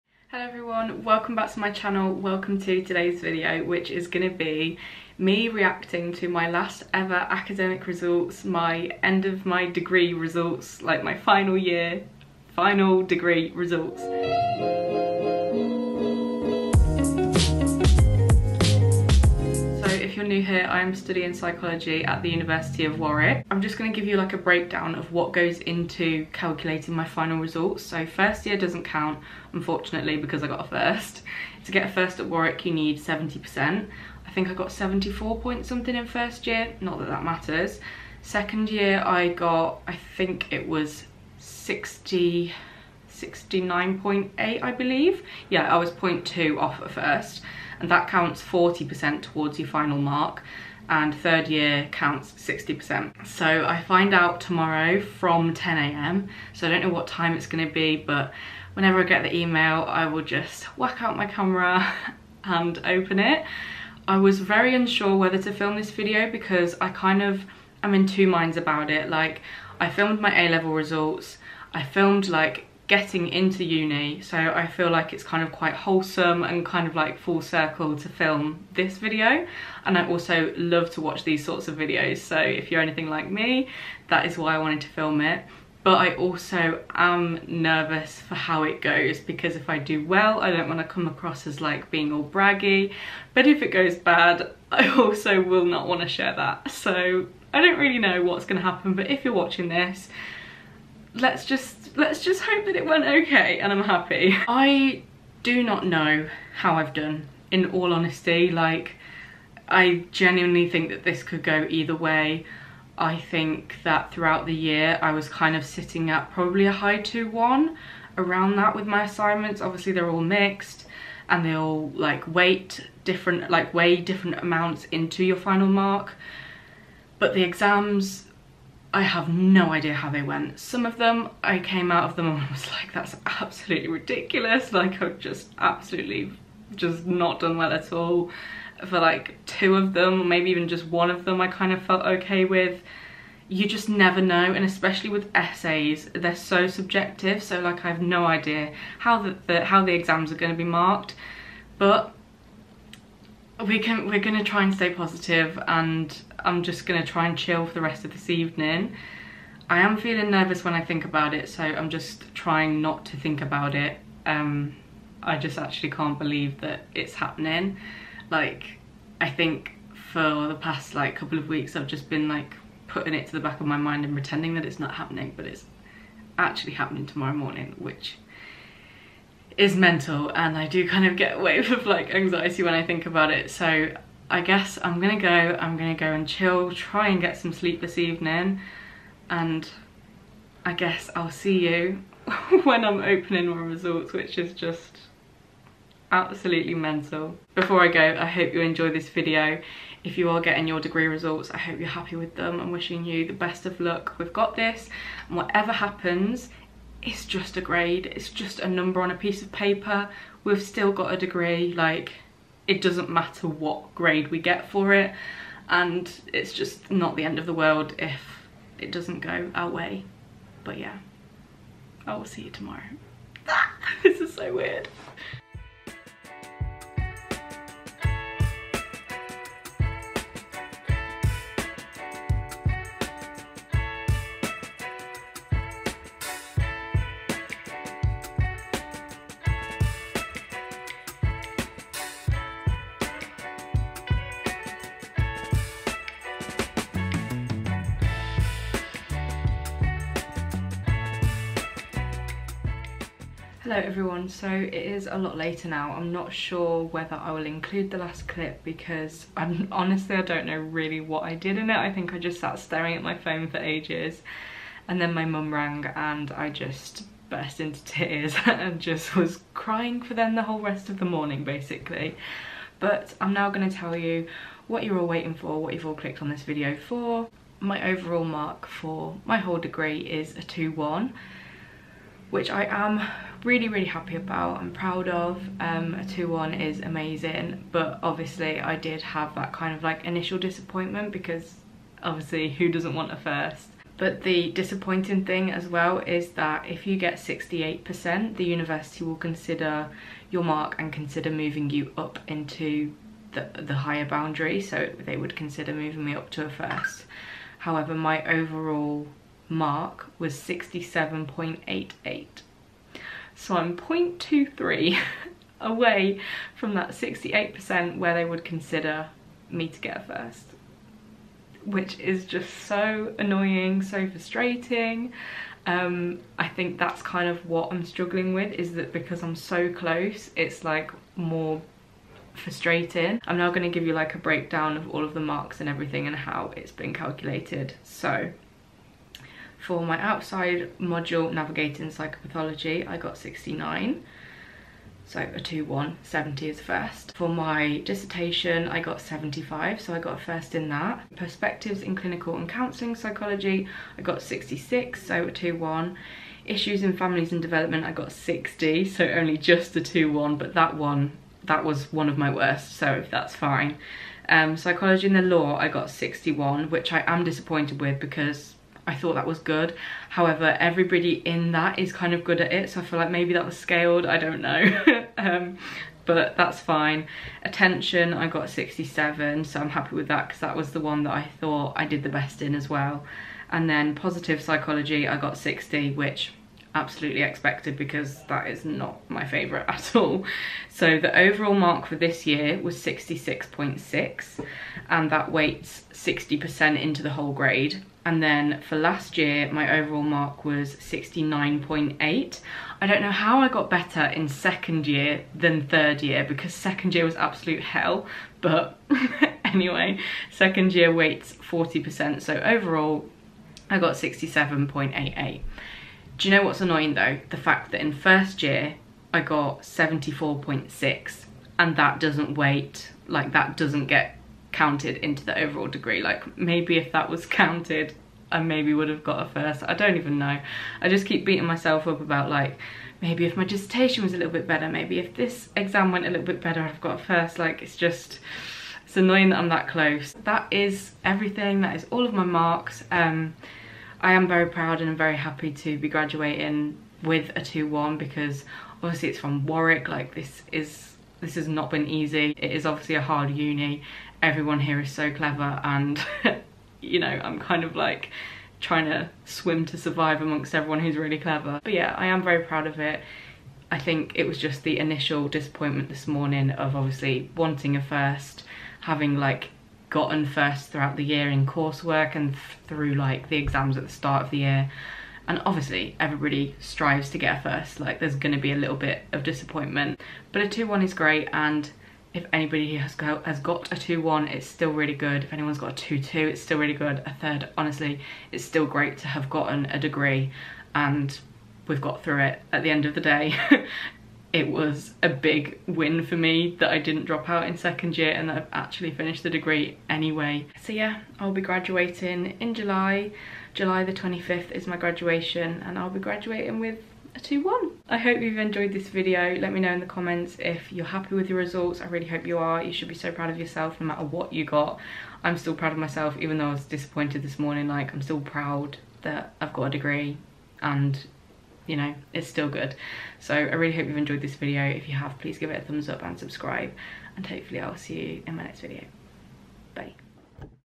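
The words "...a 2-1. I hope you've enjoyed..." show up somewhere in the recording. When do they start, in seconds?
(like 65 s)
507 s.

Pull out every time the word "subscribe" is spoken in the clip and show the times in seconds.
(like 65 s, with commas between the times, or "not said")
526 s.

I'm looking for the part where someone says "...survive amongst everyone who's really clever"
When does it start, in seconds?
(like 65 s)
459 s.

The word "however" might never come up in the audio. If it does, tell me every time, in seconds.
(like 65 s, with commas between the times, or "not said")
307 s, 370 s.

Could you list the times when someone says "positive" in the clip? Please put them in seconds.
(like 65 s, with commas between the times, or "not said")
154 s, 383 s.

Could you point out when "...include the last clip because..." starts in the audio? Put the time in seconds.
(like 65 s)
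257 s.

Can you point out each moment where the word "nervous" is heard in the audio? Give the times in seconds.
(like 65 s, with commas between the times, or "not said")
87 s, 160 s.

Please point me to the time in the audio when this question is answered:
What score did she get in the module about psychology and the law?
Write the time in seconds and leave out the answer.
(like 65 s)
365 s.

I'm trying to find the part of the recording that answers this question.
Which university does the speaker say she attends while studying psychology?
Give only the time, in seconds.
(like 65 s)
22 s.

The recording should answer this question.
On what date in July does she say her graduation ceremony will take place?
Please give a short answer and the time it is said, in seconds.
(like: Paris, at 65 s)
July 25th, at 503 s.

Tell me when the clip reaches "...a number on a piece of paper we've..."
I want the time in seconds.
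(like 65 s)
208 s.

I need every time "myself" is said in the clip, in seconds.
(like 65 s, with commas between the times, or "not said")
431 s, 515 s.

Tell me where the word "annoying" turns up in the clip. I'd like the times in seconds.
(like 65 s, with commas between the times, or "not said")
323 s, 416 s, 438 s.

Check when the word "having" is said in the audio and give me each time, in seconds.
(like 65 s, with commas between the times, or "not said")
468 s.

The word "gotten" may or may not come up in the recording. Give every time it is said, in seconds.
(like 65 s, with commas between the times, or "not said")
469 s, 489 s.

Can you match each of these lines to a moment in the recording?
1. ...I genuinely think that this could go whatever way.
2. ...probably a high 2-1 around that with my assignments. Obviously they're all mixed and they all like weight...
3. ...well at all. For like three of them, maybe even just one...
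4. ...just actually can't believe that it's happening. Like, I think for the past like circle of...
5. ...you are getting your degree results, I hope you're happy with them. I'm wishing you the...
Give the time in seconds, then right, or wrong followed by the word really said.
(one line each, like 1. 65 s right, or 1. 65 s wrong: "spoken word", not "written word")
1. 109 s wrong: "either", not "whatever"
2. 116 s right
3. 137 s wrong: "two", not "three"
4. 165 s wrong: "couple", not "circle"
5. 200 s right.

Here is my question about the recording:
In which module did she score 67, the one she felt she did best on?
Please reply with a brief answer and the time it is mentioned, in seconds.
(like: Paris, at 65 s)
Attention, at 377 s.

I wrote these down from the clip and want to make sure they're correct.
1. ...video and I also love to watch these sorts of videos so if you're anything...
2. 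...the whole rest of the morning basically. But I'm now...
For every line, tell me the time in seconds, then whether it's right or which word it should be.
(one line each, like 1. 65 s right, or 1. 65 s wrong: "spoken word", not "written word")
1. 78 s right
2. 270 s right.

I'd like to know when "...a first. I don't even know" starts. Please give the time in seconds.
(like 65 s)
429 s.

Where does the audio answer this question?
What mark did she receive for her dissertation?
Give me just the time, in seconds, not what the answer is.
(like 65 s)
349 s.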